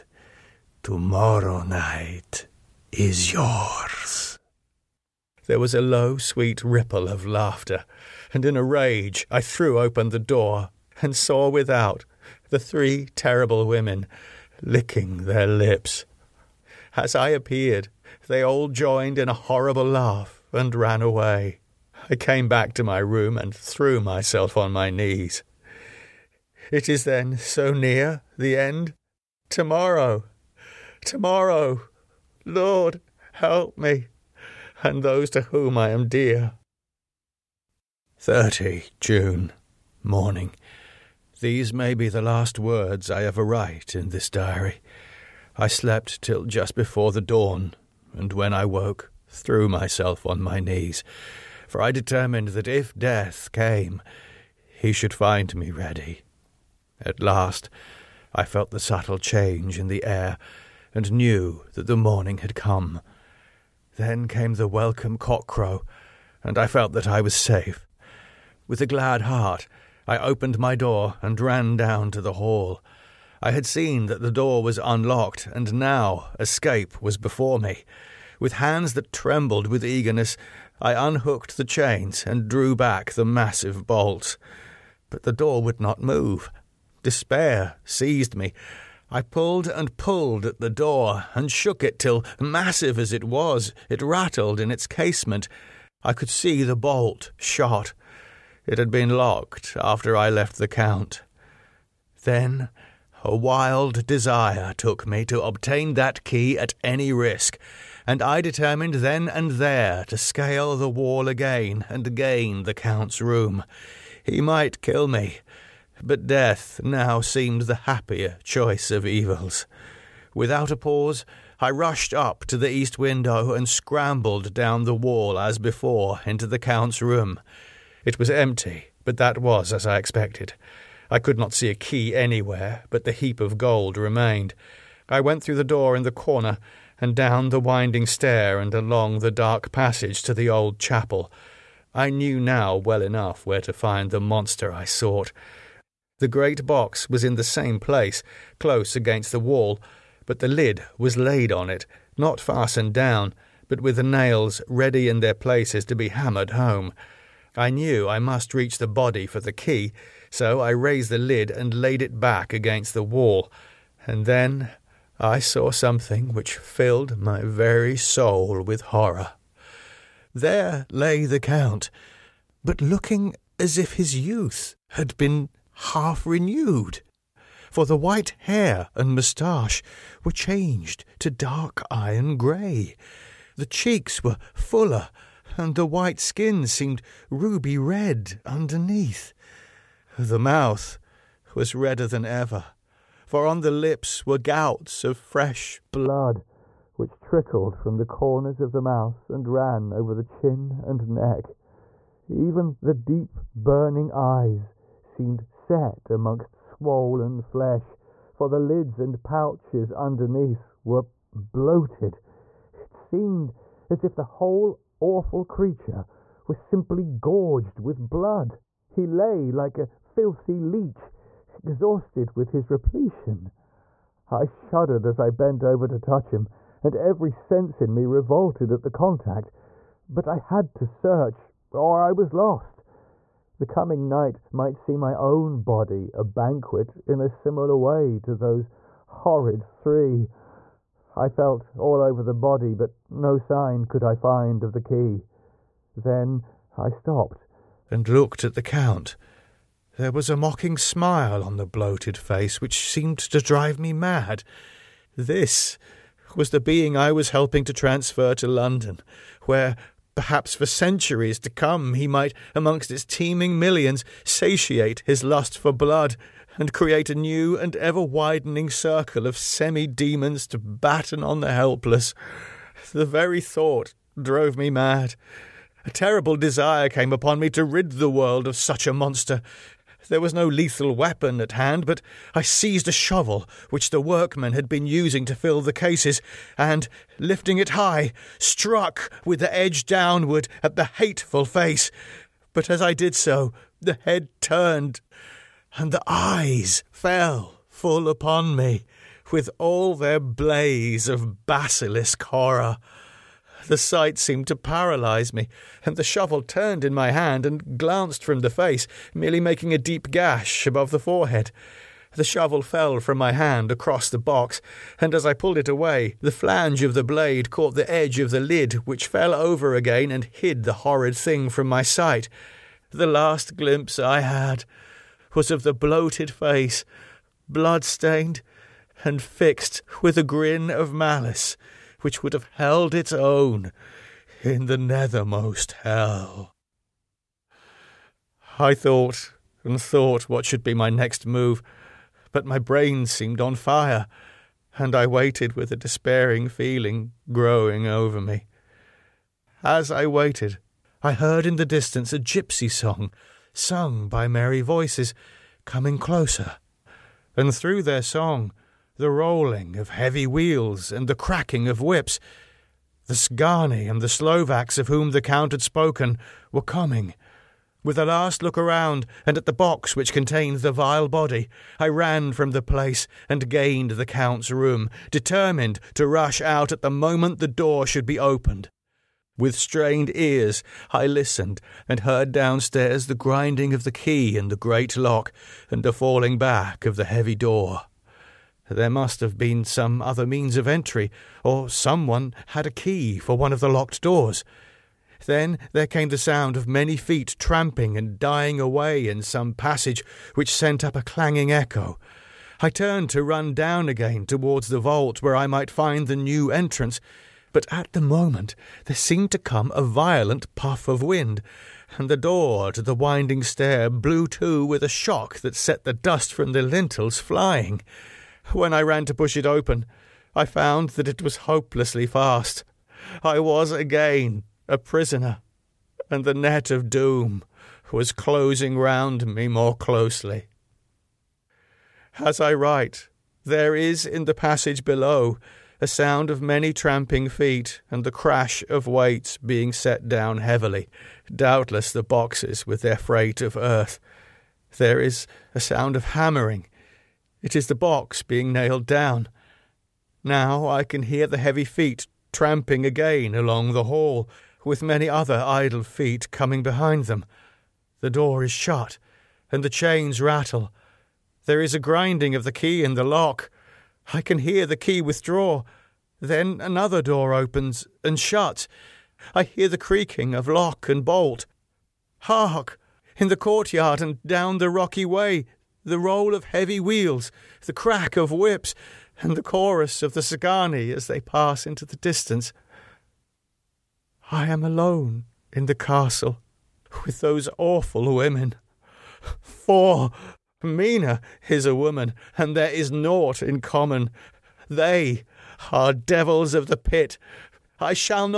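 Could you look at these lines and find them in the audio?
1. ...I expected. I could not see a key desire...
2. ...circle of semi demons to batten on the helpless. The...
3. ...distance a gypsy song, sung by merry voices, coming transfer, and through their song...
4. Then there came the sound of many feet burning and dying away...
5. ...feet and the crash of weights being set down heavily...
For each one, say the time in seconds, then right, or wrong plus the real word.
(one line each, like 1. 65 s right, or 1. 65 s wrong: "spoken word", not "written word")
1. 129 s wrong: "anywhere", not "desire"
2. 268 s right
3. 351 s wrong: "closer", not "transfer"
4. 395 s wrong: "tramping", not "burning"
5. 437 s right.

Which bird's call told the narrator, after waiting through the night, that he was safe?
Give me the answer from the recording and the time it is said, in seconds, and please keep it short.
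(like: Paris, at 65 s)
Cockcrow, at 65 s.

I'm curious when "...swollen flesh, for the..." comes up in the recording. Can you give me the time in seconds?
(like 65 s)
206 s.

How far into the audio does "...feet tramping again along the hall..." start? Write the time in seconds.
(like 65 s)
451 s.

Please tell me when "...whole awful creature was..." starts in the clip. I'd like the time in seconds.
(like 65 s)
214 s.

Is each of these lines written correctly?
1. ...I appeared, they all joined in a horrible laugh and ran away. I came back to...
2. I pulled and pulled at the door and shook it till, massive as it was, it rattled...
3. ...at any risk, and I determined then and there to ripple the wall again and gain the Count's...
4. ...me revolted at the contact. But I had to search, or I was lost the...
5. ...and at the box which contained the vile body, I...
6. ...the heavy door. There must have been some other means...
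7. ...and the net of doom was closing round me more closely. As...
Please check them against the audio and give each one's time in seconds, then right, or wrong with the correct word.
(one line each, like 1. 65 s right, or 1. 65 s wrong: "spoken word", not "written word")
1. 17 s right
2. 89 s right
3. 106 s wrong: "scale", not "ripple"
4. 227 s right
5. 369 s right
6. 386 s right
7. 426 s right.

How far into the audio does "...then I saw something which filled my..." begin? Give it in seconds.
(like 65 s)
164 s.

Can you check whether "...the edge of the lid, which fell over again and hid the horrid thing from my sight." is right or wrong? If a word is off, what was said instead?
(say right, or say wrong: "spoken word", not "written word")
right.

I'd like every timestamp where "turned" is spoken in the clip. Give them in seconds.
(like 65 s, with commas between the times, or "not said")
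294 s, 306 s, 402 s.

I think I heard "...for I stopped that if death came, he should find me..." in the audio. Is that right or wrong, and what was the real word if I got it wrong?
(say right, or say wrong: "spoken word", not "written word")
wrong: "determined", not "stopped".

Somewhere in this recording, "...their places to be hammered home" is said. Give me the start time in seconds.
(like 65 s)
155 s.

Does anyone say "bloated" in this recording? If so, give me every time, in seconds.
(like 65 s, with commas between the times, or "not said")
211 s, 251 s, 325 s.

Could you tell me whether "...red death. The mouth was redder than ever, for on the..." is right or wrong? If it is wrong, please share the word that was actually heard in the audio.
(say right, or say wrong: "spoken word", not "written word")
wrong: "underneath", not "death".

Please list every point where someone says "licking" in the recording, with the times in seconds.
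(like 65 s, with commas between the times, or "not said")
14 s.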